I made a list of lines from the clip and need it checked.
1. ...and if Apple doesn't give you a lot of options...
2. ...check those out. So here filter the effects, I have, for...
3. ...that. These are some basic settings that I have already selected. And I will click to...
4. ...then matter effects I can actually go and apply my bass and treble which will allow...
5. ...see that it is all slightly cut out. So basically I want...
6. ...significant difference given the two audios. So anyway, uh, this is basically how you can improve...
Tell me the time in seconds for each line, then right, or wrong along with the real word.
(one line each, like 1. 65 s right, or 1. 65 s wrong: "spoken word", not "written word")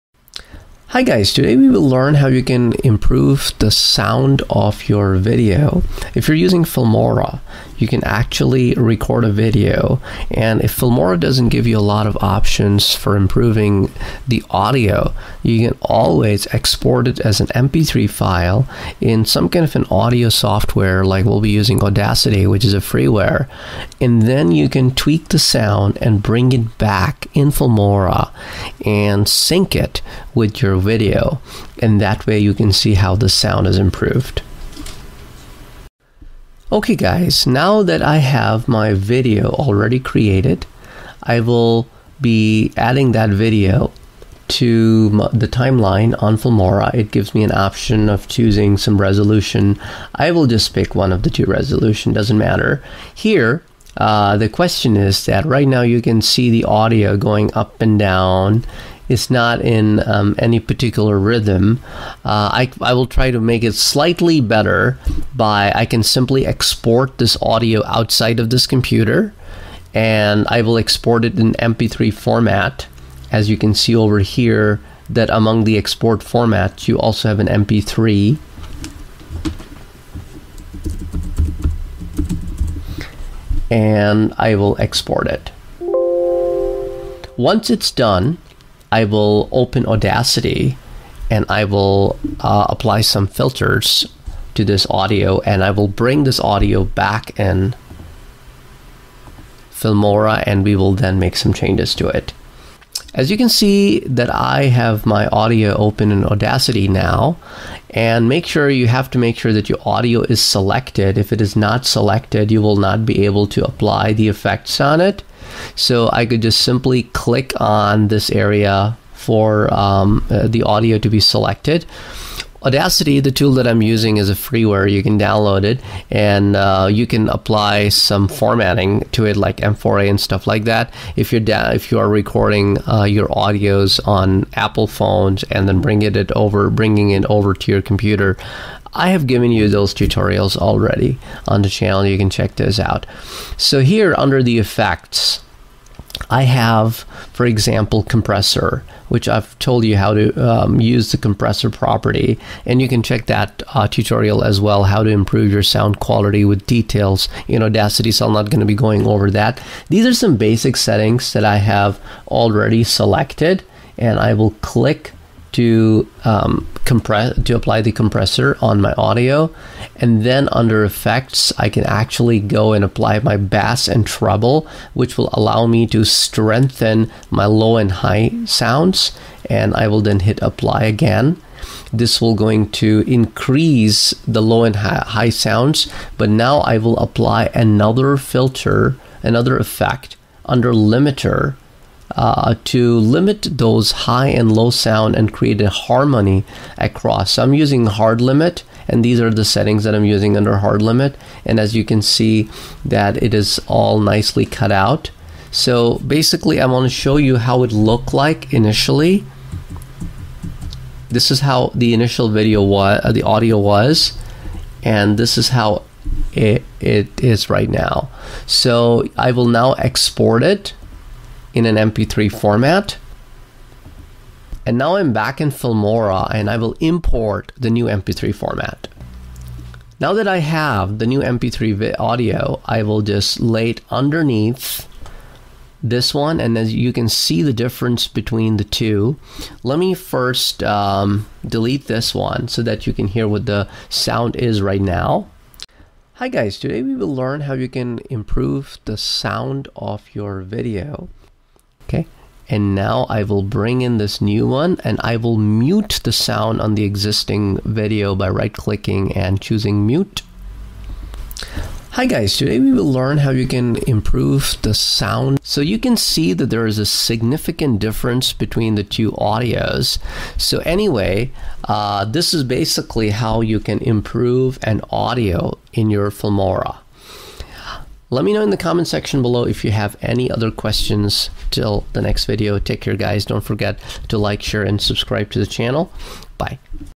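1. 10 s wrong: "Filmora", not "Apple"
2. 142 s wrong: "under", not "filter"
3. 159 s right
4. 170 s wrong: "under", not "matter"
5. 202 s wrong: "nicely", not "slightly"
6. 266 s wrong: "between", not "given".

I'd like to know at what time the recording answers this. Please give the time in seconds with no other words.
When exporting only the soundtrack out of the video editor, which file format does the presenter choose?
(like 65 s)
70 s.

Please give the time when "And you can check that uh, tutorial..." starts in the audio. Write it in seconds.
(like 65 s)
152 s.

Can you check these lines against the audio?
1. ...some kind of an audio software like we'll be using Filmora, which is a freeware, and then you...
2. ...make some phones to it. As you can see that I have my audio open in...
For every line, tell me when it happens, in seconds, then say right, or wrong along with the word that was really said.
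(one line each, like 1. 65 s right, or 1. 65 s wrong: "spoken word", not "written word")
1. 19 s wrong: "Audacity", not "Filmora"
2. 101 s wrong: "changes", not "phones".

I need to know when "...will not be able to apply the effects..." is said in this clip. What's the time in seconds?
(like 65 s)
112 s.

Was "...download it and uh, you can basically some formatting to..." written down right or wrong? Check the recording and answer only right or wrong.
wrong.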